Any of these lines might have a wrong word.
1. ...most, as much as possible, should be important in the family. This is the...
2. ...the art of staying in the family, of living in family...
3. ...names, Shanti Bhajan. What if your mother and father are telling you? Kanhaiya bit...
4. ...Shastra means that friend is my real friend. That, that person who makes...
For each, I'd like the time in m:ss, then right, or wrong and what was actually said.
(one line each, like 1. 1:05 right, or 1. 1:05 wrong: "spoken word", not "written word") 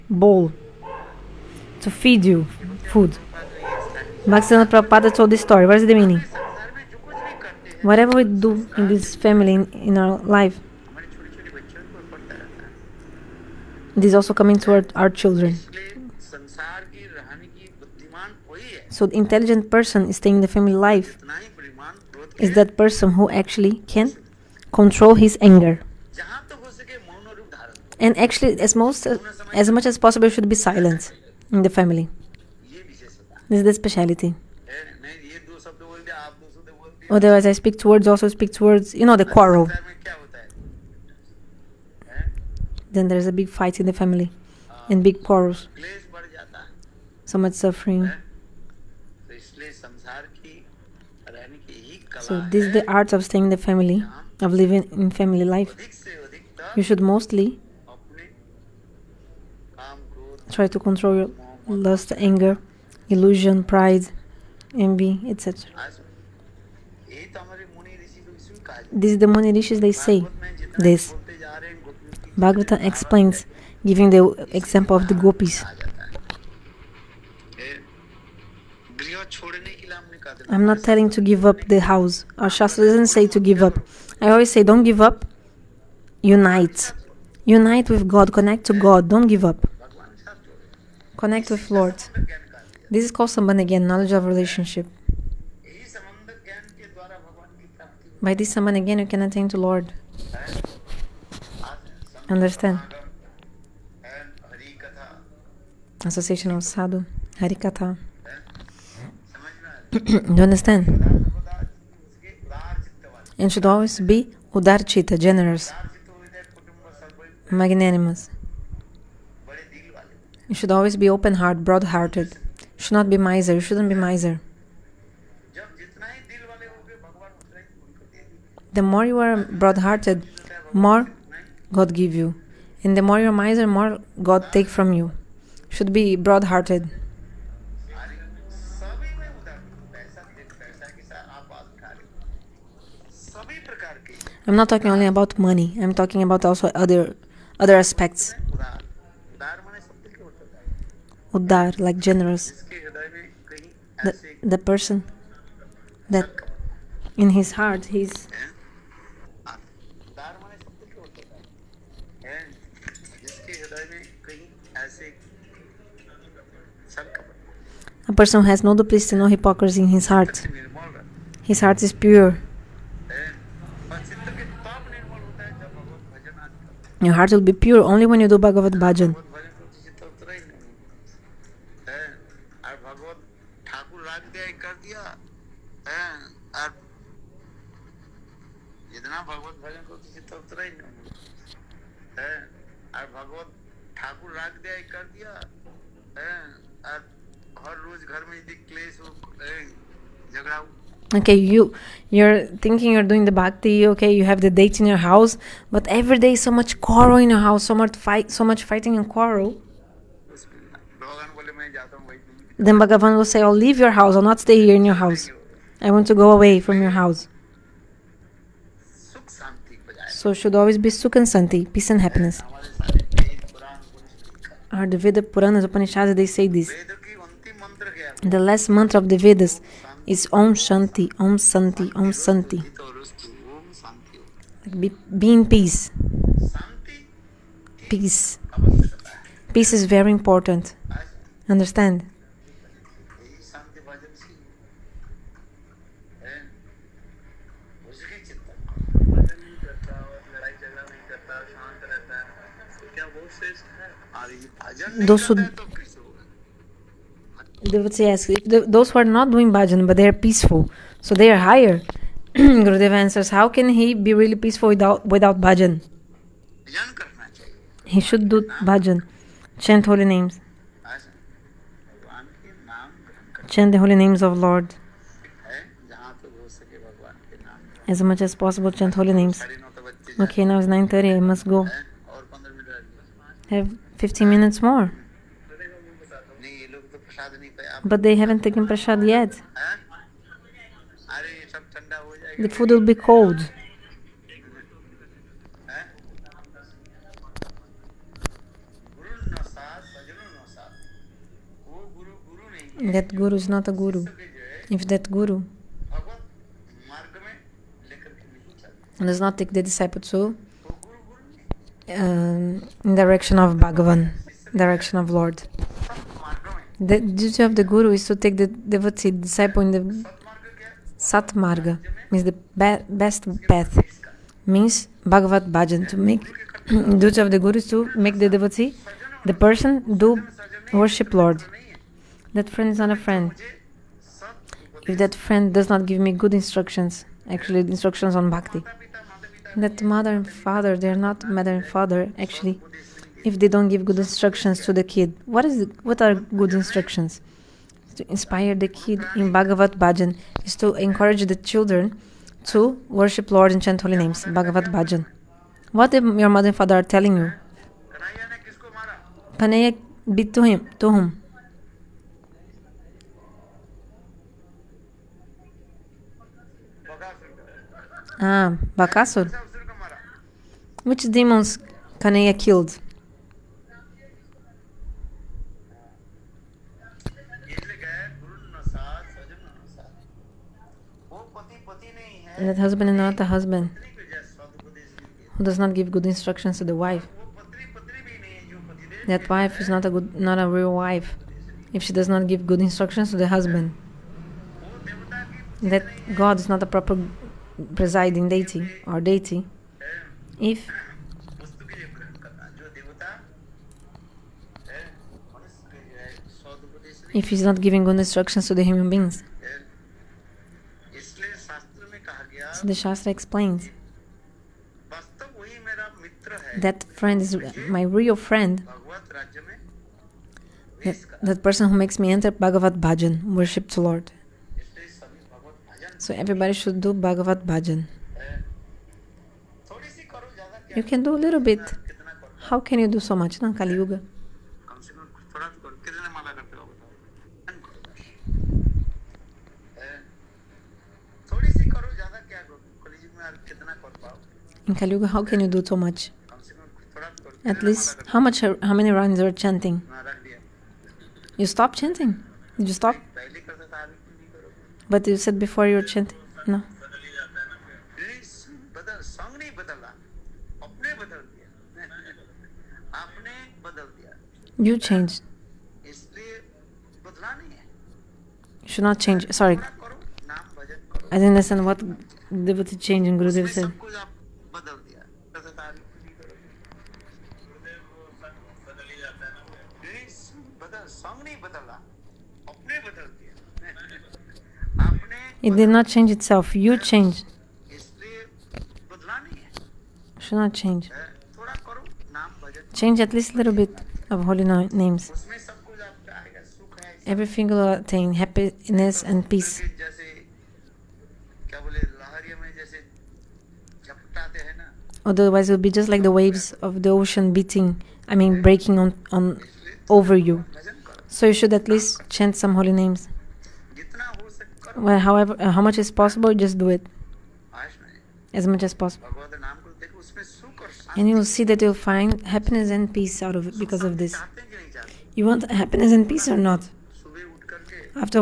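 1. 0:28 wrong: "silent", not "important"
2. 0:52 right
3. 5:53 wrong: "Bhagavad", not "Shanti"
4. 6:52 wrong: "explains", not "means".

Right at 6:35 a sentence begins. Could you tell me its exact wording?
That God is not a proper presiding deity or deity, if if he's not giving good instructions to the human beings.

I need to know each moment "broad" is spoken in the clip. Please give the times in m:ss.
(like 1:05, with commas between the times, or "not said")
2:01, 2:09, 2:16.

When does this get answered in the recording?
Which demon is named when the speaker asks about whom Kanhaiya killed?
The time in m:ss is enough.
6:08.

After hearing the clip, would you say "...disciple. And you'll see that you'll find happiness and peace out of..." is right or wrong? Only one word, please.
wrong.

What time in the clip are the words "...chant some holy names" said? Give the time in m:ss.
8:32.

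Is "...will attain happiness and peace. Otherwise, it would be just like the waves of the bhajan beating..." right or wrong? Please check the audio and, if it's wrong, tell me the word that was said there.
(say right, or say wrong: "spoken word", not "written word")
wrong: "ocean", not "bhajan".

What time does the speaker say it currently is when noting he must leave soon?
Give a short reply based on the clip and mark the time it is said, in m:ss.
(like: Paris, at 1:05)
9:30, at 4:40.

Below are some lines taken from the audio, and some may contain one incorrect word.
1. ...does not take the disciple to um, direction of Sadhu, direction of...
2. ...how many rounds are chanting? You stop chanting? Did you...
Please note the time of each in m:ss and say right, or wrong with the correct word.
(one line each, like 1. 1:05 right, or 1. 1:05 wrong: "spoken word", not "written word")
1. 5:08 wrong: "Bhagavan", not "Sadhu"
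2. 7:28 right.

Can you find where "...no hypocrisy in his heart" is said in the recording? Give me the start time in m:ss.
2:49.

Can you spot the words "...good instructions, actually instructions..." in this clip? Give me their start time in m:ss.
5:36.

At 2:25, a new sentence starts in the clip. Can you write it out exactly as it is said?
I'm talking about also other other aspects.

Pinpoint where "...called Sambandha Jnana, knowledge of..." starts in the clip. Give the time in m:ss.
1:33.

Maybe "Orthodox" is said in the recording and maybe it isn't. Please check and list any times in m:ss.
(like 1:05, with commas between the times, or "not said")
not said.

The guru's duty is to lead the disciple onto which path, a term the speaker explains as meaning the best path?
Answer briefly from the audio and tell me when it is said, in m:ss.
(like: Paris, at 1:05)
Satmarga, at 5:20.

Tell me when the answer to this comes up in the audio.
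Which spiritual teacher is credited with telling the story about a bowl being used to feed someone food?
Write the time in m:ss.
0:04.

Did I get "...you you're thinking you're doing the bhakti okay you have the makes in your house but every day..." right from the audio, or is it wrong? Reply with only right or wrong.
wrong.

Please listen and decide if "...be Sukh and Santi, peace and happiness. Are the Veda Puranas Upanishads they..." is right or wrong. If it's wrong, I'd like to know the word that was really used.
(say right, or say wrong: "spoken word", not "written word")
right.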